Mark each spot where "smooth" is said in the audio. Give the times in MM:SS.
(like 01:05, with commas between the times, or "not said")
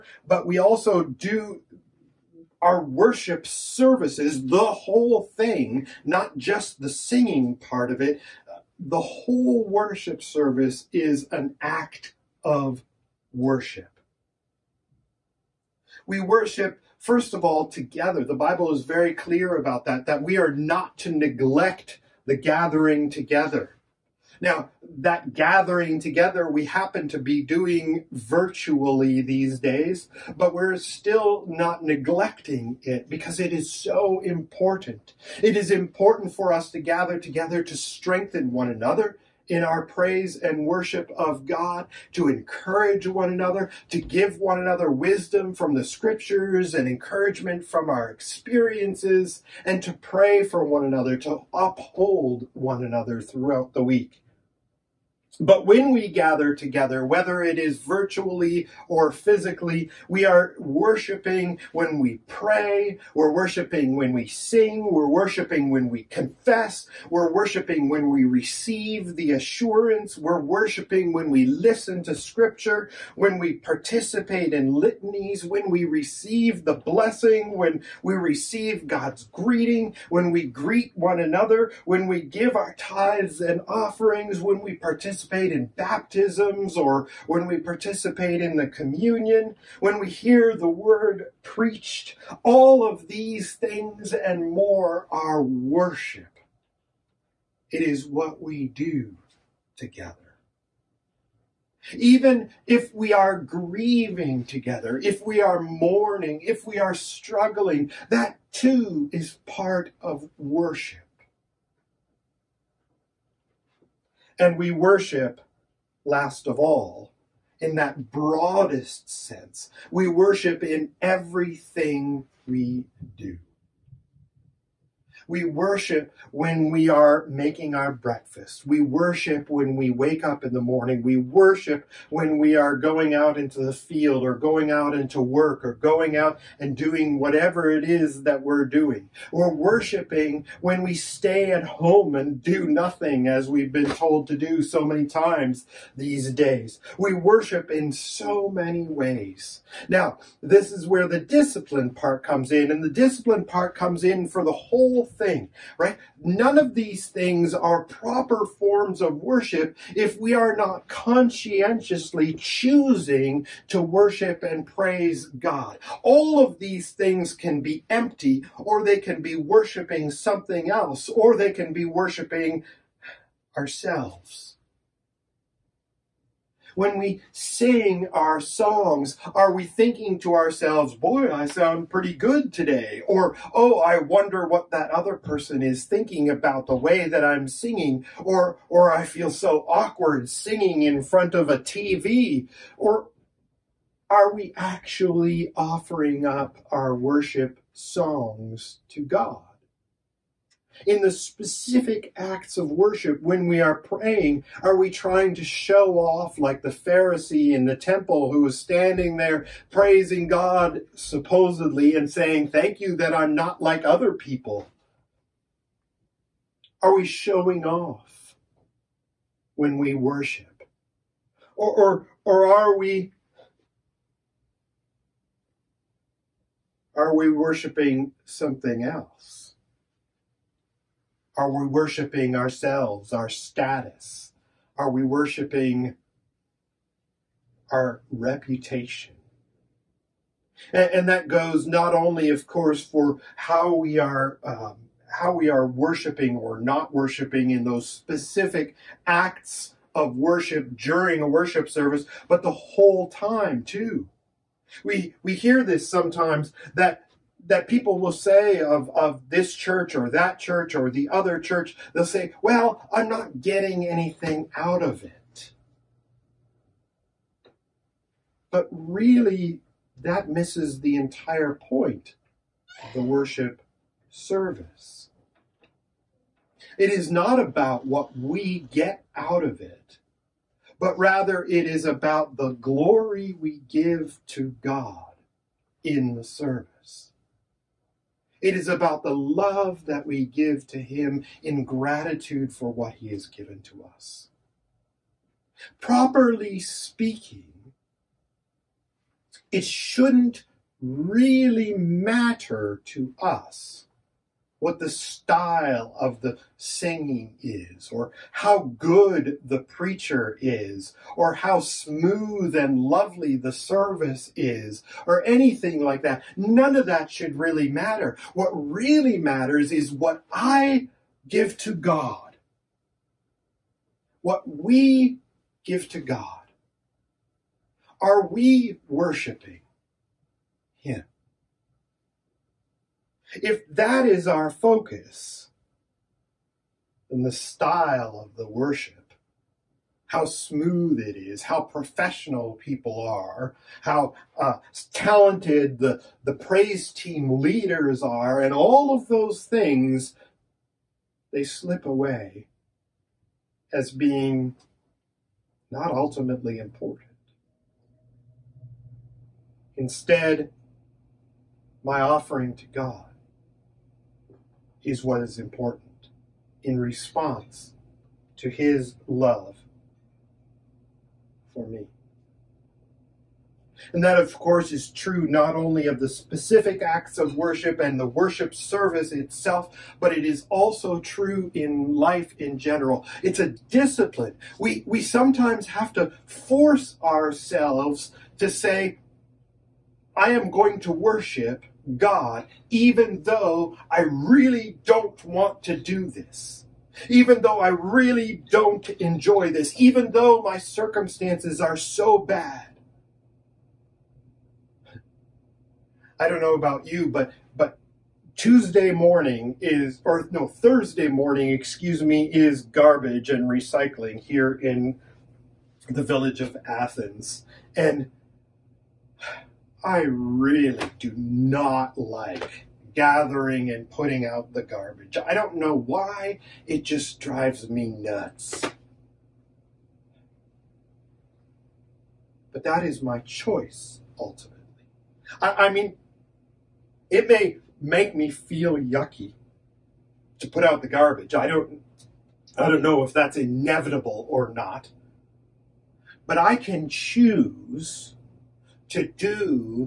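05:11, 05:40.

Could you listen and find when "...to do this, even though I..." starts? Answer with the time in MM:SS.
06:35.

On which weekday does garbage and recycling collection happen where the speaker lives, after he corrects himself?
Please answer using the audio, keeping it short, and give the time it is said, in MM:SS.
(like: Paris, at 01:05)
Thursday, at 06:50.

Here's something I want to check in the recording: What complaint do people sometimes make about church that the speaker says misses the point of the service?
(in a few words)
I'm not getting anything out of it.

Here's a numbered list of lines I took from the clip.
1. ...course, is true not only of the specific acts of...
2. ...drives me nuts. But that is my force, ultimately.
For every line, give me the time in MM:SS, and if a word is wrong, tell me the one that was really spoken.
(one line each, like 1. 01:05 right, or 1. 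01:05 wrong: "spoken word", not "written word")
1. 06:14 right
2. 07:07 wrong: "choice", not "force".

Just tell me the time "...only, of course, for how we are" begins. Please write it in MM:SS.
04:01.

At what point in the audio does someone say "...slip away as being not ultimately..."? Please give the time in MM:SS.
05:51.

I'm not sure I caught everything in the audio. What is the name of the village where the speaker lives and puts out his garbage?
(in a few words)
Athens.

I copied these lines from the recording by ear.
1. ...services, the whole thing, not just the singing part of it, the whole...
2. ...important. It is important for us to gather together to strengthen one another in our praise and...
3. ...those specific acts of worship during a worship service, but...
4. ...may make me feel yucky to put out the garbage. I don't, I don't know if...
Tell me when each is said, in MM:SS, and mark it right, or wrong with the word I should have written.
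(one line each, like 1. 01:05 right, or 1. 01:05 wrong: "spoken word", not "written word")
1. 00:03 right
2. 00:34 right
3. 04:07 right
4. 07:17 right.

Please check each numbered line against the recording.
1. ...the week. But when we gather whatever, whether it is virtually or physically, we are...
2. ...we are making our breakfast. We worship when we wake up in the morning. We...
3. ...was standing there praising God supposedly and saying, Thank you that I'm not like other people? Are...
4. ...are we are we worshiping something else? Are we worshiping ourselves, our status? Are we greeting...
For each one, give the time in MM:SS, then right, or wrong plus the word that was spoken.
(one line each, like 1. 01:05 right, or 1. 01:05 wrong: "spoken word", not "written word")
1. 00:53 wrong: "together", not "whatever"
2. 02:06 right
3. 03:28 right
4. 03:42 wrong: "worshiping", not "greeting".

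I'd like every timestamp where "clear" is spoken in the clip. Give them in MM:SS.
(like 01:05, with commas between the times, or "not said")
00:19.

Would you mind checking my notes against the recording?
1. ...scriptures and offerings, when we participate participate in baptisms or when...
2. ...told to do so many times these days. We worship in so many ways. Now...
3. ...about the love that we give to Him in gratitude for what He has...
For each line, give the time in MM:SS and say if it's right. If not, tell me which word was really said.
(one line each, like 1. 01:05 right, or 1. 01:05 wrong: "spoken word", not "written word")
1. 01:22 wrong: "tithes", not "scriptures"
2. 02:23 right
3. 04:48 right.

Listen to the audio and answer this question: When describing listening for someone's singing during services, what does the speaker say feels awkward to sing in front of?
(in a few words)
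A TV.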